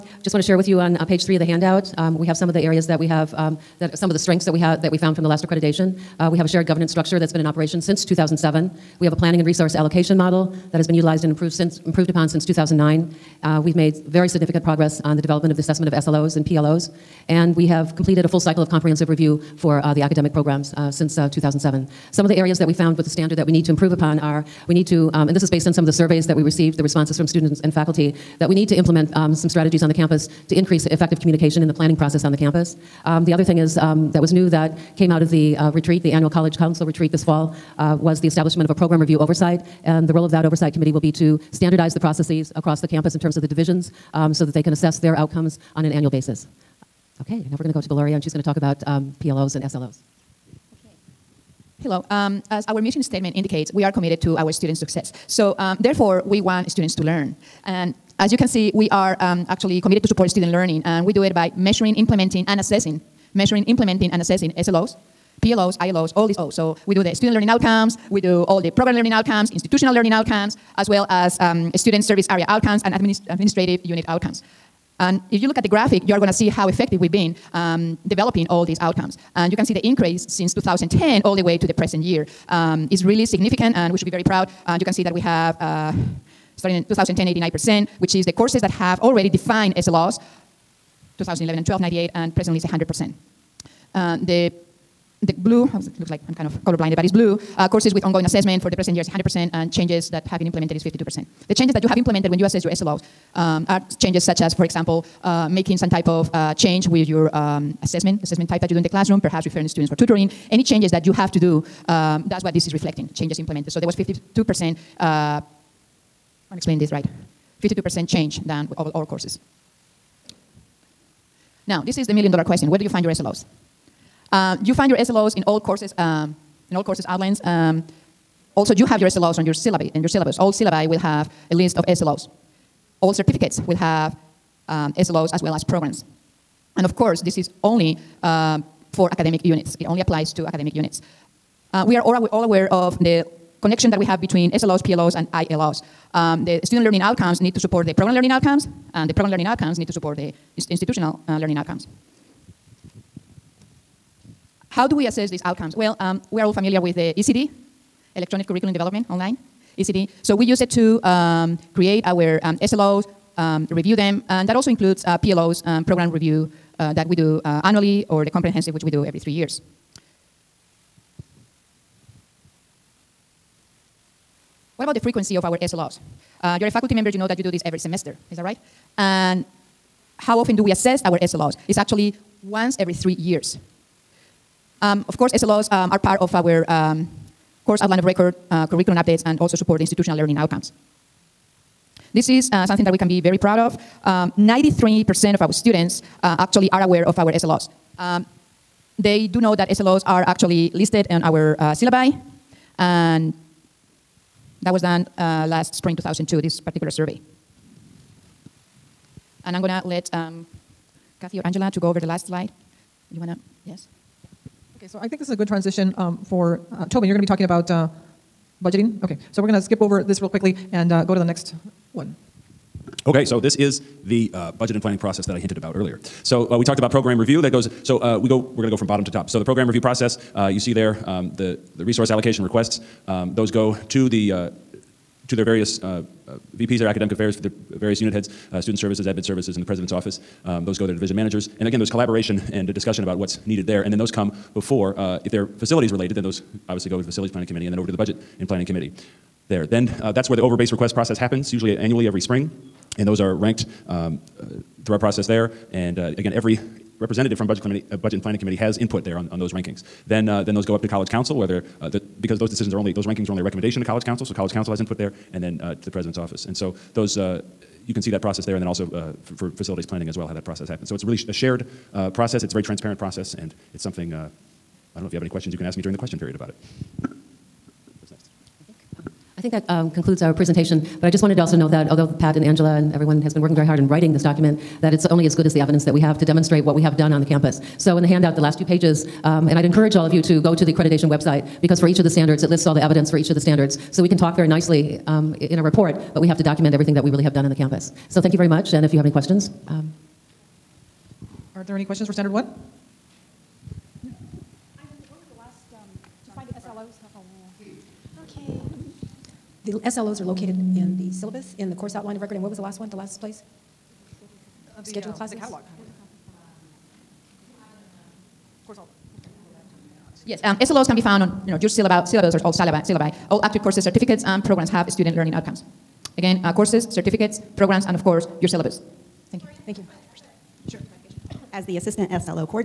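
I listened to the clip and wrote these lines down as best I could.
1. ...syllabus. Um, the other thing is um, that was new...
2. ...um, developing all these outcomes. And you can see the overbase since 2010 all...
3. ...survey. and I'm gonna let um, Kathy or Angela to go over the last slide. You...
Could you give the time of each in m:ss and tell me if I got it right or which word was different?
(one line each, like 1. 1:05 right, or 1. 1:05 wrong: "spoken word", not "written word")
1. 0:32 wrong: "campus", not "syllabus"
2. 1:17 wrong: "increase", not "overbase"
3. 3:26 right.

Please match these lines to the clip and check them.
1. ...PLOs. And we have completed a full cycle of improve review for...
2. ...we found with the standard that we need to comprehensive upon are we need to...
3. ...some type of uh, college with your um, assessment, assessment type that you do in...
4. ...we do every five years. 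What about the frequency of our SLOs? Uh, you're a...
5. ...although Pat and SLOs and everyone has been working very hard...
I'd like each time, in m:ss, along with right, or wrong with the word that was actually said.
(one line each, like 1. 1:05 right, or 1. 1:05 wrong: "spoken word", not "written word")
1. 0:16 wrong: "comprehensive", not "improve"
2. 0:22 wrong: "improve", not "comprehensive"
3. 1:45 wrong: "change", not "college"
4. 2:48 wrong: "three", not "five"
5. 4:41 wrong: "Angela", not "SLOs".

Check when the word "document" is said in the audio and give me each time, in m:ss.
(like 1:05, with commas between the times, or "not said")
4:44, 4:56.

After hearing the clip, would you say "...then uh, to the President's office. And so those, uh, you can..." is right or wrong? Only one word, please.
right.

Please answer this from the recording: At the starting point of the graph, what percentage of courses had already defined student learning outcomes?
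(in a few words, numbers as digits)
89%.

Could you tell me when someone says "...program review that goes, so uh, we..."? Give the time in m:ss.
3:46.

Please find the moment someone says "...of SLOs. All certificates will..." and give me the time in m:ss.
2:11.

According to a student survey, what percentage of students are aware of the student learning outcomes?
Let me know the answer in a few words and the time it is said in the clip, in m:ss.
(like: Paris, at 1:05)
93%, at 3:14.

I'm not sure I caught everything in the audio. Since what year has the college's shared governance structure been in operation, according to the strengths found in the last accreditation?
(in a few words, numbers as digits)
2007.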